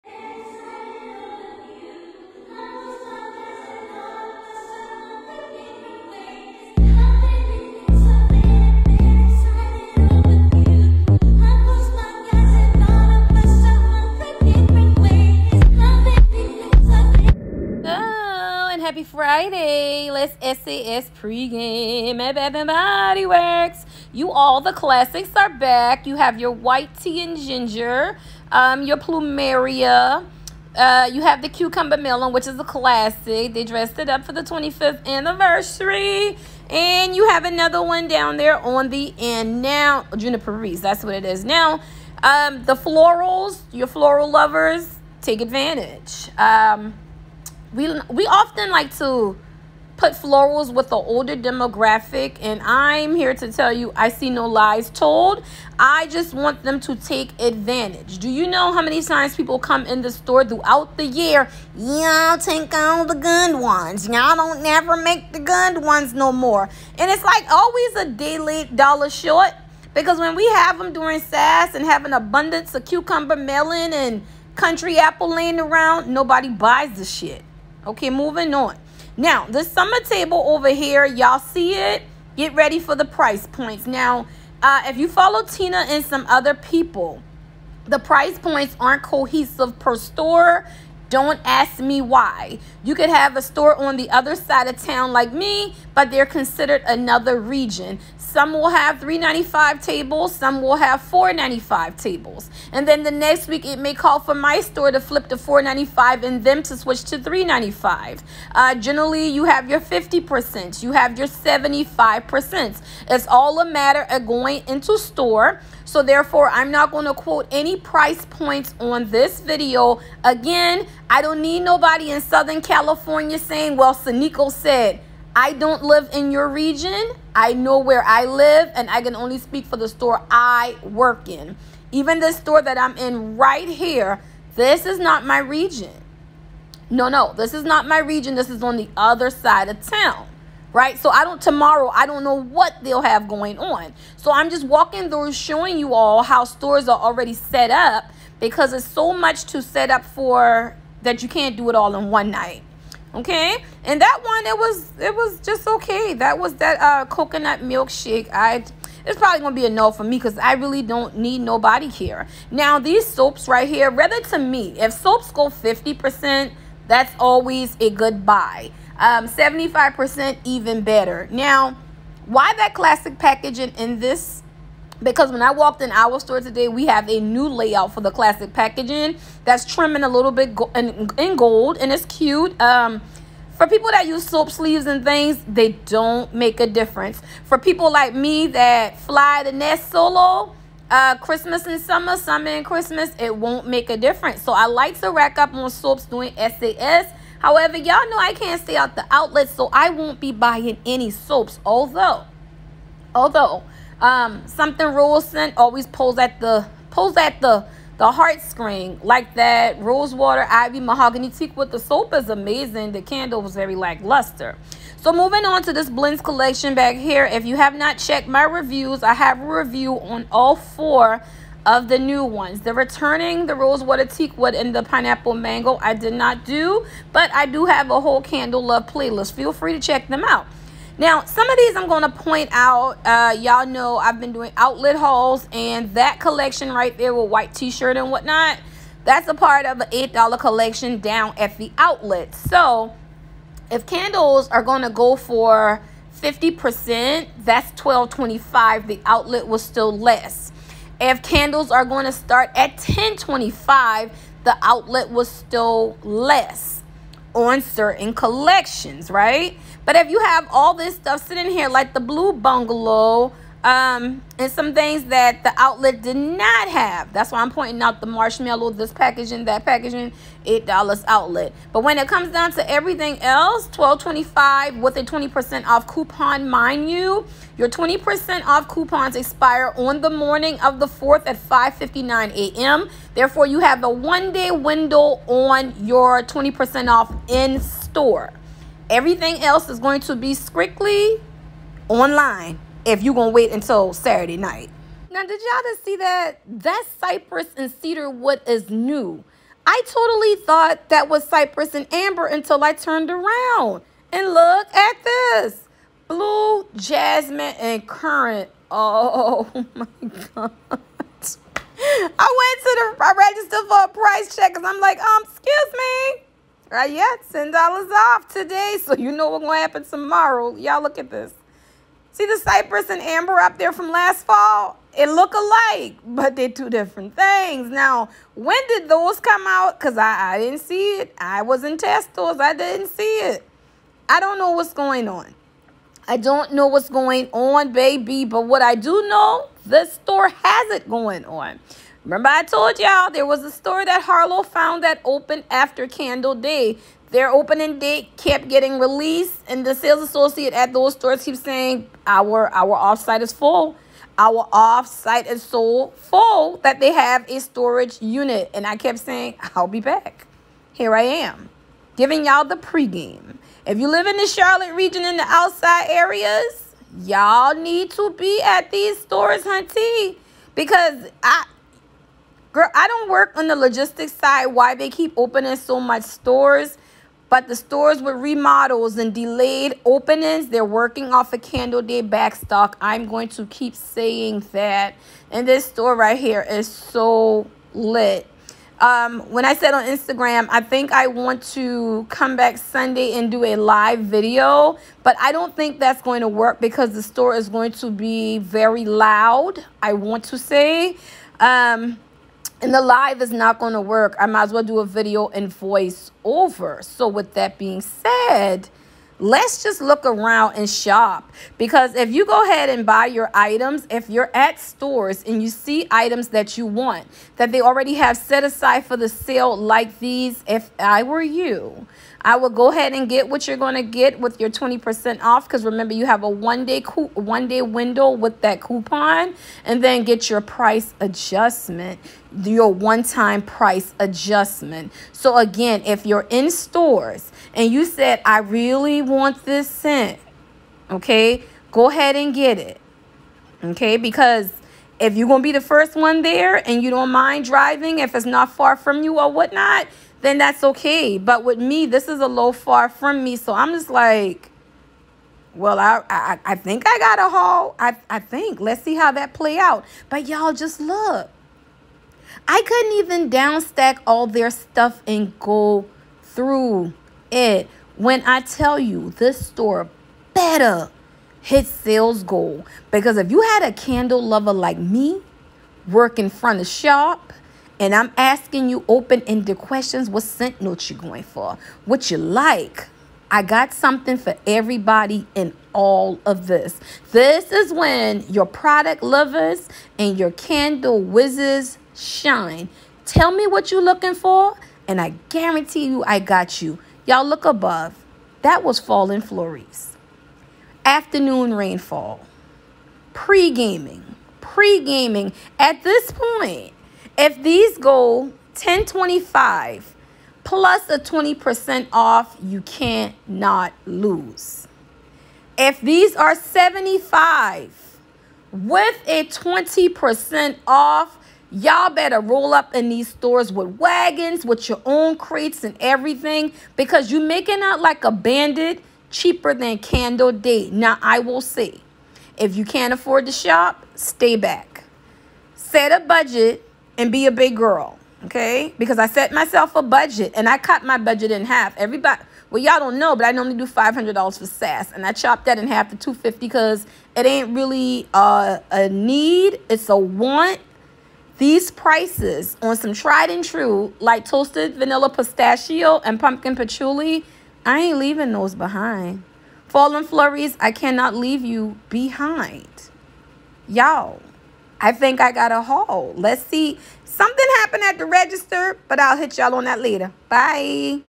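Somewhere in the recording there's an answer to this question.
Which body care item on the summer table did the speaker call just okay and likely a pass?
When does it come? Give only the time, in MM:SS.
02:37.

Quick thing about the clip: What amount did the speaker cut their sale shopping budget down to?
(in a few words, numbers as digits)
250.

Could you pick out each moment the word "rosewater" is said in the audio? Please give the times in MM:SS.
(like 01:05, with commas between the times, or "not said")
03:29, 03:43.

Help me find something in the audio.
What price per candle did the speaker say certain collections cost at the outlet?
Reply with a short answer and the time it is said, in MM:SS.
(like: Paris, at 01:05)
$8, at 03:59.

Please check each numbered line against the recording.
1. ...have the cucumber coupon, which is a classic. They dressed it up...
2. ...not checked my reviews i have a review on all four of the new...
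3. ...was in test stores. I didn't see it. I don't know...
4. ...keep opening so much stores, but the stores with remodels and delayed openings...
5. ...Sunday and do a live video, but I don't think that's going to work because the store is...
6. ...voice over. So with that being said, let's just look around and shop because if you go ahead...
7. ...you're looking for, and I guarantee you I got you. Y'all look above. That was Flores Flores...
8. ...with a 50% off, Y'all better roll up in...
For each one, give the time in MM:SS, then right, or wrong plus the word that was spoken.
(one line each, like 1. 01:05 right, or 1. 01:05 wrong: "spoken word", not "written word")
1. 00:31 wrong: "melon", not "coupon"
2. 03:37 right
3. 05:31 right
4. 06:14 right
5. 06:32 right
6. 06:45 right
7. 08:13 wrong: "Fallen", not "Flores"
8. 08:38 wrong: "20", not "50".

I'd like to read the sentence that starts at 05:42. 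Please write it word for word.
Remember, I told y'all there was a store that Harlow found that opened after Candle Day.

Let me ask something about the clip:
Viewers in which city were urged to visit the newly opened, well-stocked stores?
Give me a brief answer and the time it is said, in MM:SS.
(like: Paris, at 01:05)
Charlotte, at 06:04.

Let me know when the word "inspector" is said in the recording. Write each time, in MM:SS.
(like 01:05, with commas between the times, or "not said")
not said.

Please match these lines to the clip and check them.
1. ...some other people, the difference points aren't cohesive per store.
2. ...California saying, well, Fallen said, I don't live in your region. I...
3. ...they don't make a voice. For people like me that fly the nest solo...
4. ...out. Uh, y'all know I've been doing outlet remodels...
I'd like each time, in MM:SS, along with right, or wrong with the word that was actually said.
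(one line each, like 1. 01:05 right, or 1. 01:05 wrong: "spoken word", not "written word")
1. 01:26 wrong: "price", not "difference"
2. 02:02 wrong: "Sneiko", not "Fallen"
3. 03:05 wrong: "difference", not "voice"
4. 03:52 wrong: "hauls", not "remodels".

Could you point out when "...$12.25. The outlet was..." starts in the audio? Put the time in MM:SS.
04:07.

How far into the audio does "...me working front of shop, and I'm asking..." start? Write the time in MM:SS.
07:54.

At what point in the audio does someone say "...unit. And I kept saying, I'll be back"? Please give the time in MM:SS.
05:58.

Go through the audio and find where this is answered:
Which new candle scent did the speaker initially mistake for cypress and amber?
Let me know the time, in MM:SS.
04:56.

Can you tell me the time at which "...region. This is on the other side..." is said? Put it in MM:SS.
02:17.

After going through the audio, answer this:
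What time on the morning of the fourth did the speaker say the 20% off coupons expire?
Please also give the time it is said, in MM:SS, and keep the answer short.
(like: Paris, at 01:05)
5:59 a.m., at 04:41.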